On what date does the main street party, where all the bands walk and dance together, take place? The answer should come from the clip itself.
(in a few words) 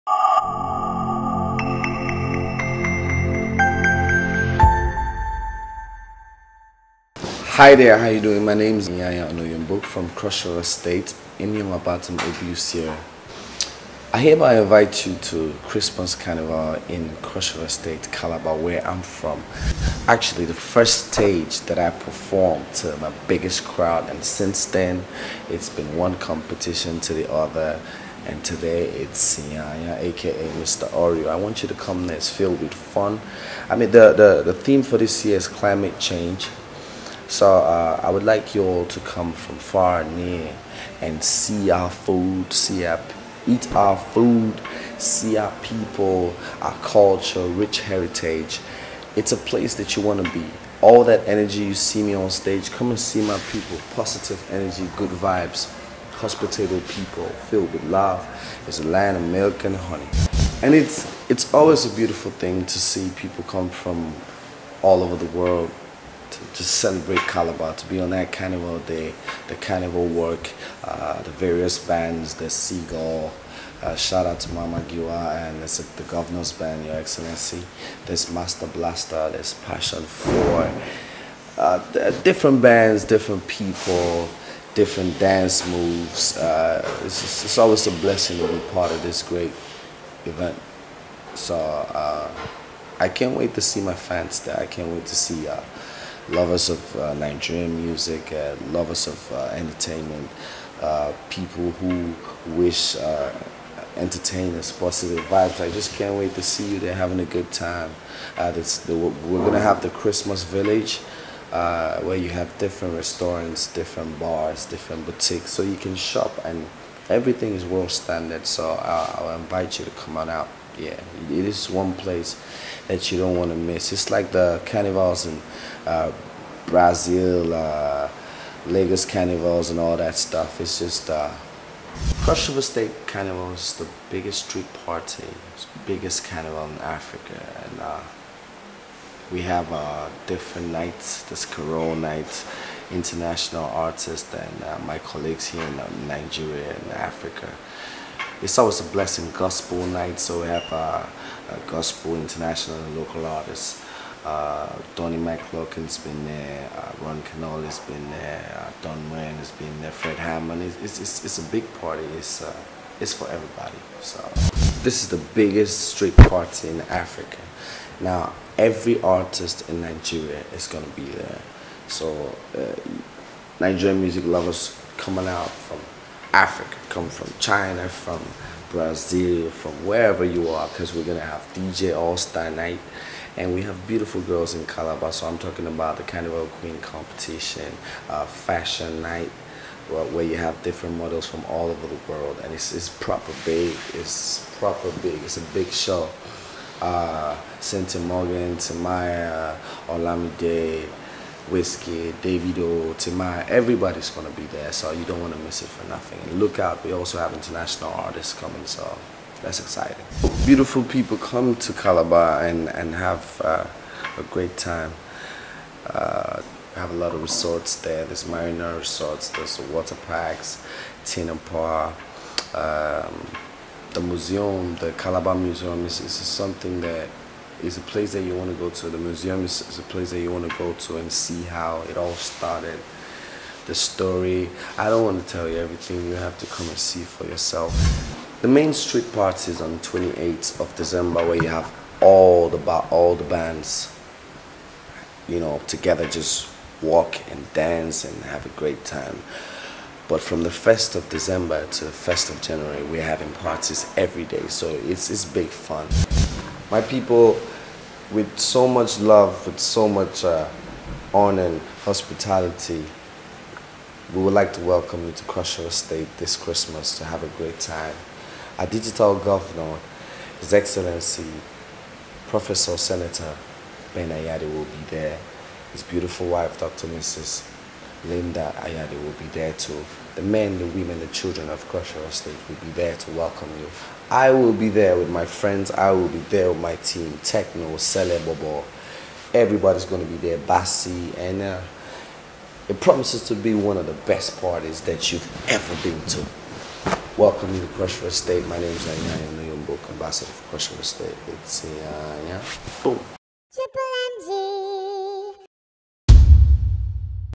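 28th of December.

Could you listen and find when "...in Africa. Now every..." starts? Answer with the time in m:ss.
2:46.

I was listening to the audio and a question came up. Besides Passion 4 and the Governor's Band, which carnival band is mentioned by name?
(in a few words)
Master Blaster.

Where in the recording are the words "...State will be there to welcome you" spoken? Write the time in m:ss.
4:42.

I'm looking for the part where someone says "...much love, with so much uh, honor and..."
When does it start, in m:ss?
4:18.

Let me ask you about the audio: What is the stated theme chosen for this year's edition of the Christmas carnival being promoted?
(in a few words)
Climate change.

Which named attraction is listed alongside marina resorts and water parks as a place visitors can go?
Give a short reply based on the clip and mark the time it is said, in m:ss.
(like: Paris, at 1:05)
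Tinapa, at 3:41.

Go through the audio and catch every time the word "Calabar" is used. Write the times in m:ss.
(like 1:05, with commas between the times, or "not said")
0:18, 1:07, 3:04, 3:31, 3:44.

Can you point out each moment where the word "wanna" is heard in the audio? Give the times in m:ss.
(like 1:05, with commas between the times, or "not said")
3:25.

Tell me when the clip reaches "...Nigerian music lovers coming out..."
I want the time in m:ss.
2:53.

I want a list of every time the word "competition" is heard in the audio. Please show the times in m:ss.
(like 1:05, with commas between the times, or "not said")
0:26, 3:06.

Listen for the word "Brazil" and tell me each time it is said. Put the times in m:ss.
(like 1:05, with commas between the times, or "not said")
2:06, 2:58.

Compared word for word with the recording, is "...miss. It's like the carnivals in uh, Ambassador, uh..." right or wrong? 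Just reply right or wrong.
wrong.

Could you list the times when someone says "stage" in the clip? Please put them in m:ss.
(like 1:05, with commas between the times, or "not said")
0:21, 0:52.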